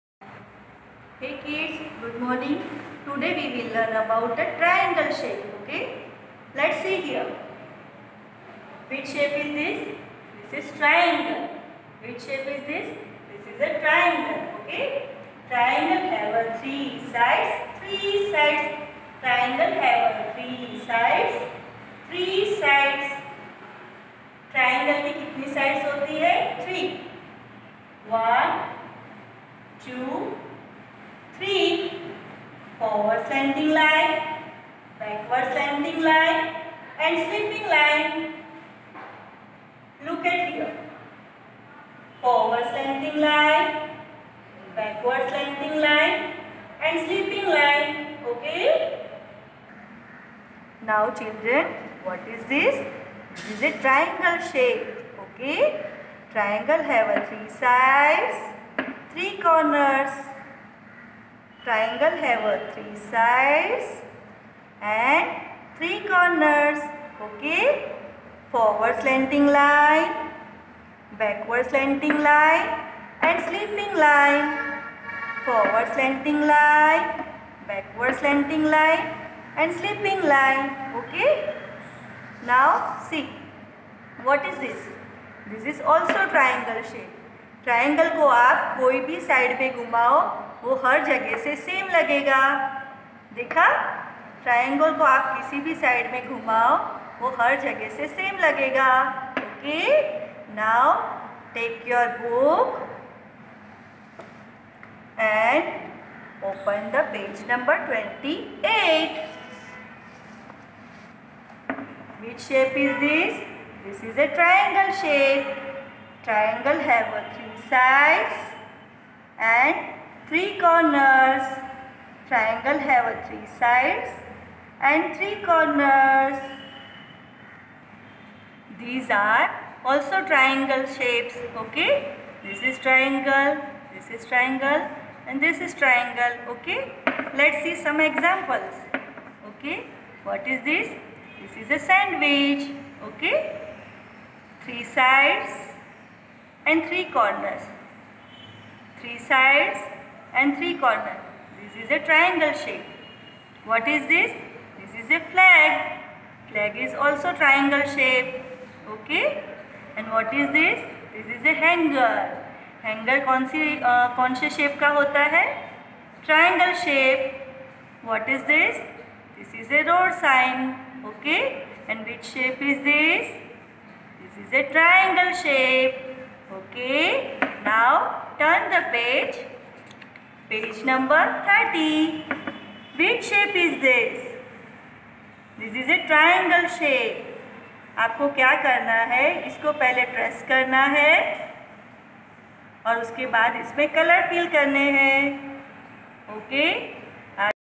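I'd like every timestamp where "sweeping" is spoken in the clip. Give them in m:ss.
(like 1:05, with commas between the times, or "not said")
0:37, 0:47.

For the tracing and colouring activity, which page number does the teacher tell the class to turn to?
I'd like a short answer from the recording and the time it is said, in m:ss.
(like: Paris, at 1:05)
30, at 3:00.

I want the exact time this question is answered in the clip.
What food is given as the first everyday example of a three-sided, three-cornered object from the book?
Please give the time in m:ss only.
2:21.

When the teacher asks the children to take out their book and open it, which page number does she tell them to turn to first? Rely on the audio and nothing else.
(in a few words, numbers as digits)
28.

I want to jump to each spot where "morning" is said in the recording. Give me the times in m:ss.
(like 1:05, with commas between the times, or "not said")
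0:02.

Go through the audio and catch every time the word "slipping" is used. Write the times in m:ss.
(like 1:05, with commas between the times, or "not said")
1:13, 1:19.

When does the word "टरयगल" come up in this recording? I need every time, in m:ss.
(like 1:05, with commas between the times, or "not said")
1:27, 1:34.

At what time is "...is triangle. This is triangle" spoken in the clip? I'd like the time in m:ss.
2:12.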